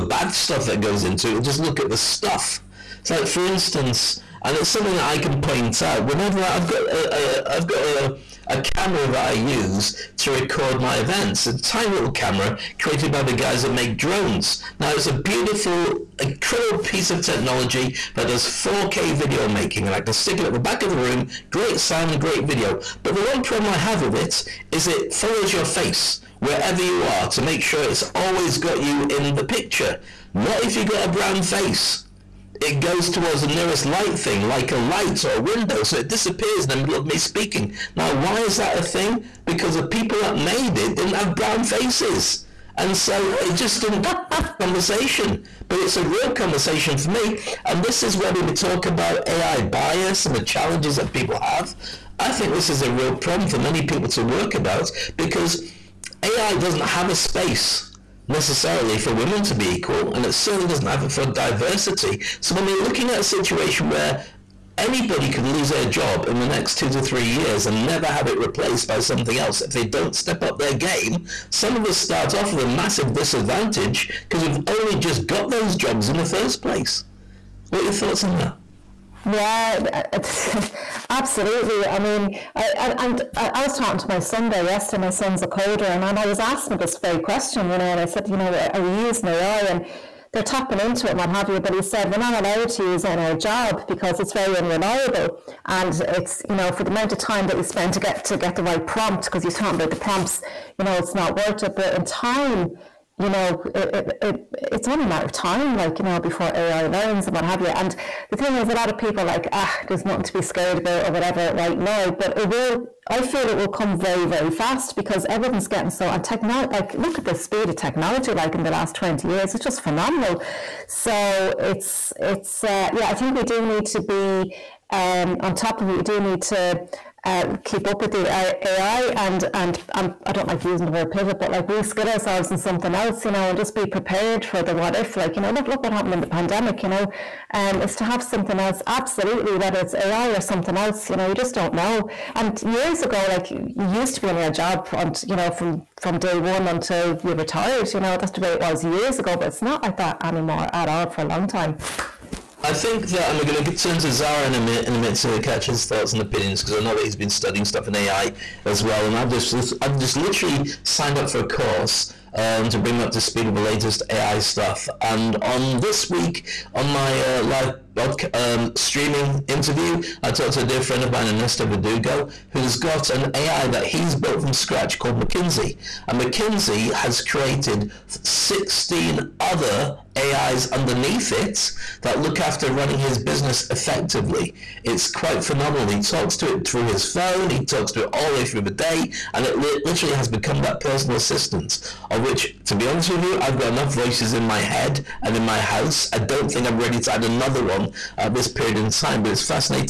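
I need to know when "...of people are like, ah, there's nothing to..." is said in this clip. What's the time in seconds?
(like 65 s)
108 s.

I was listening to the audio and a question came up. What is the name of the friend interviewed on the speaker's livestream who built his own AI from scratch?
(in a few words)
Ernesto Verdugo.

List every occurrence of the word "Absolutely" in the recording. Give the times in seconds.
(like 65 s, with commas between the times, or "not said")
81 s, 138 s.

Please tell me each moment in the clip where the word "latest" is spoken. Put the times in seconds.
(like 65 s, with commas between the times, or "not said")
163 s.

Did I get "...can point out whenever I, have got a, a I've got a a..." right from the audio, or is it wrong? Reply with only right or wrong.
right.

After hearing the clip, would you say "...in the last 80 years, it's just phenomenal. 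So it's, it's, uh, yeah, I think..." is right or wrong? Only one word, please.
wrong.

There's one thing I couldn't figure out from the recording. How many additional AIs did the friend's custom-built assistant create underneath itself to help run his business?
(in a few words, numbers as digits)
16.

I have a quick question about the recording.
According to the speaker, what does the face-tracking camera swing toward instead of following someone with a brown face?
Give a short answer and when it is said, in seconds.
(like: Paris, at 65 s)
a light or a window, at 34 s.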